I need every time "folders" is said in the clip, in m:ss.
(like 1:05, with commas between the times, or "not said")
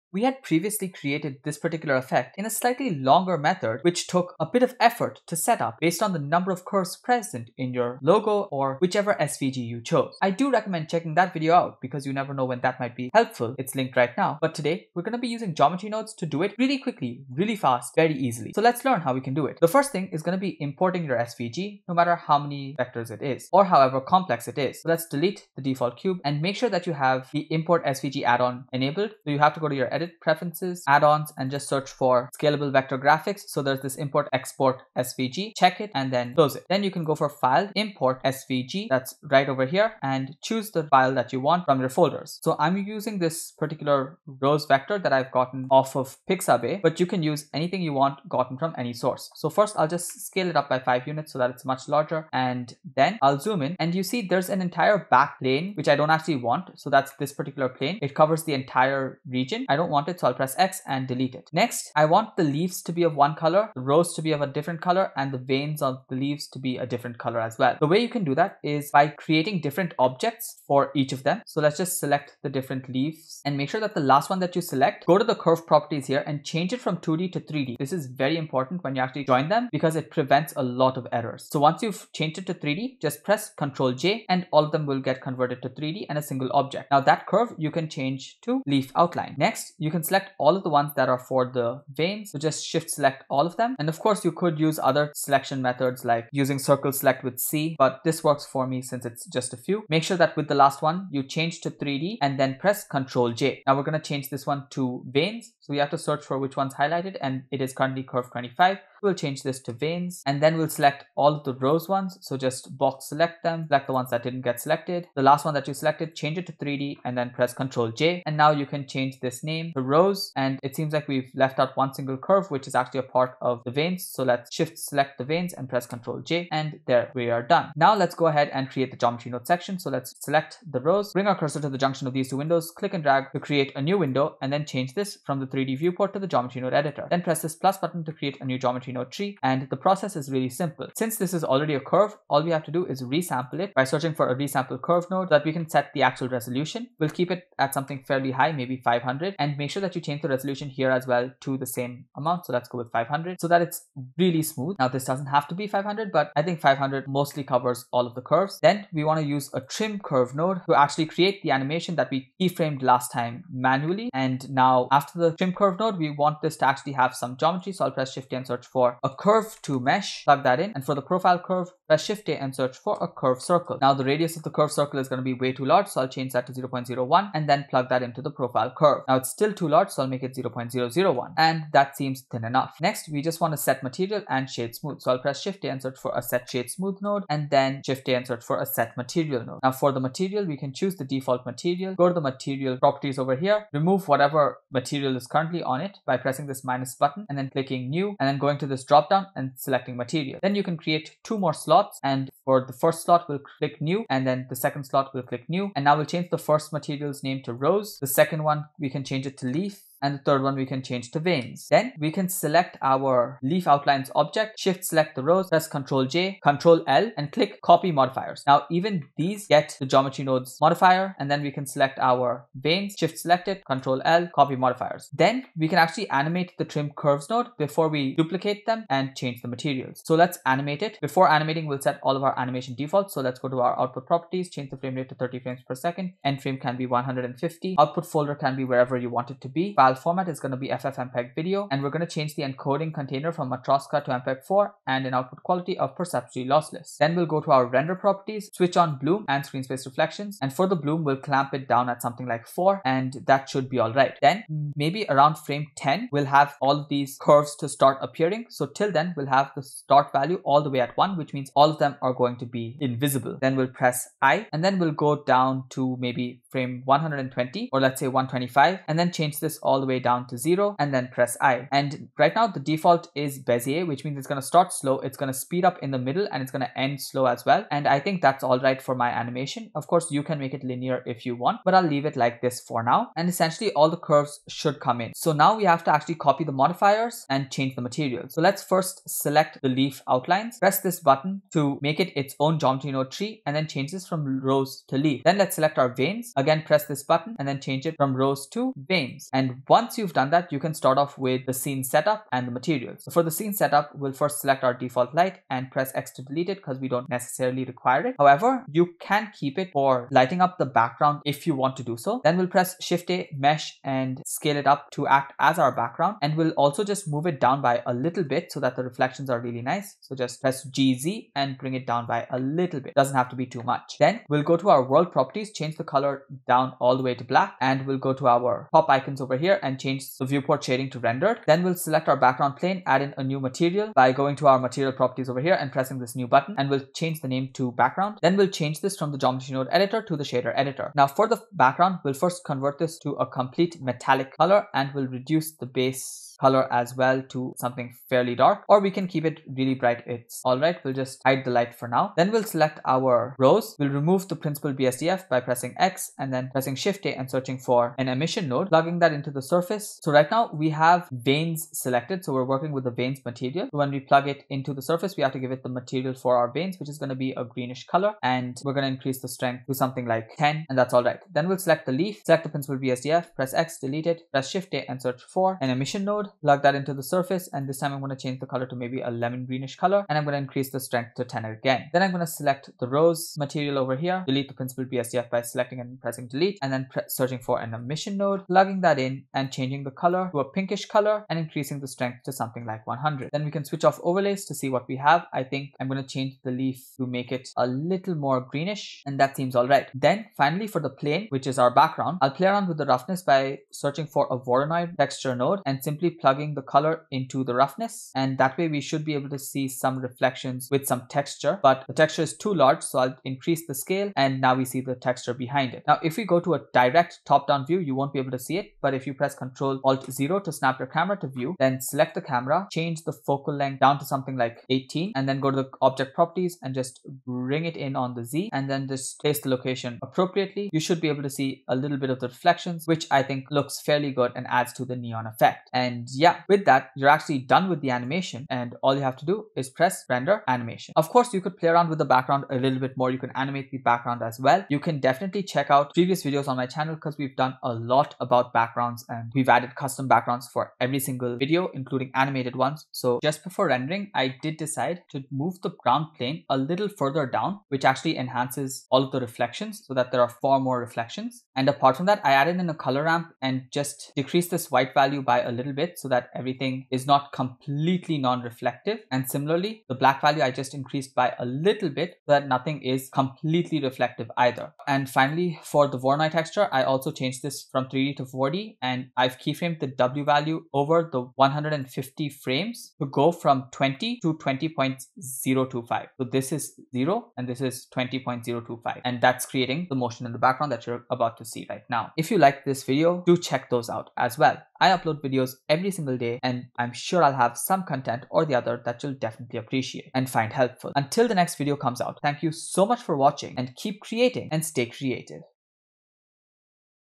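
0:41, 3:58.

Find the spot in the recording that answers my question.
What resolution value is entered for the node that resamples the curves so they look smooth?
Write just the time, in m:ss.
2:28.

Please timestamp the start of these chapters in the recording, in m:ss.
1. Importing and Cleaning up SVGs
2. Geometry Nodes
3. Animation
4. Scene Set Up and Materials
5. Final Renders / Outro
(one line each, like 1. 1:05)
1. 0:20
2. 2:07
3. 3:50
4. 5:00
5. 8:12.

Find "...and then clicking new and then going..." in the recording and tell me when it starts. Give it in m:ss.
3:17.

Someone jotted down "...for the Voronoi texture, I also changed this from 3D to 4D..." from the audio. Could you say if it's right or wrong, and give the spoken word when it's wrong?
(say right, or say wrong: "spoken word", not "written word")
right.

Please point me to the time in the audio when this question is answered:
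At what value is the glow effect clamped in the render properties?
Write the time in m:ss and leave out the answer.
4:12.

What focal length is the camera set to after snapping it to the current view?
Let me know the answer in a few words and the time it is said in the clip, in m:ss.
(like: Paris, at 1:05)
18, at 7:04.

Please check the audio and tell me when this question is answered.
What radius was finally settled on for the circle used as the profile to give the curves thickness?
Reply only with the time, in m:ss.
3:00.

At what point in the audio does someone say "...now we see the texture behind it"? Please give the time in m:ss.
6:54.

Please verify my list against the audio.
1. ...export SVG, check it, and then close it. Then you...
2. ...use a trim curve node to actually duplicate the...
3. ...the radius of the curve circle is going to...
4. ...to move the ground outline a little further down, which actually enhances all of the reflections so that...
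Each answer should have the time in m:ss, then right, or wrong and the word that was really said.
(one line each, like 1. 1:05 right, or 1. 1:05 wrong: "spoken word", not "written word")
1. 0:34 right
2. 2:39 wrong: "create", not "duplicate"
3. 2:53 right
4. 7:35 wrong: "plane", not "outline".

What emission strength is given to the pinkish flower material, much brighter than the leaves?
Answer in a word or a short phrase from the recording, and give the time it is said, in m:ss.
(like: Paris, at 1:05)
100, at 6:32.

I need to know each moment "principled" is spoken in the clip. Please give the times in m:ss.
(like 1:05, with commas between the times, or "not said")
5:54, 6:12, 6:24.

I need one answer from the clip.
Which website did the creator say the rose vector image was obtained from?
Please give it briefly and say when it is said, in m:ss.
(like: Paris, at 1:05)
Pixabay, at 0:46.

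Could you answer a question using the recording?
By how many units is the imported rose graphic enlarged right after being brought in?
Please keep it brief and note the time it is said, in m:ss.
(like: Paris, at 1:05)
5, at 0:50.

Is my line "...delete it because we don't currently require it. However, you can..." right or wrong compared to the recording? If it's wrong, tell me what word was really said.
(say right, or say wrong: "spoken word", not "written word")
wrong: "necessarily", not "currently".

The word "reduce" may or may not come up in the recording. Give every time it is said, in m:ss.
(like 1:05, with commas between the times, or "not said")
5:45.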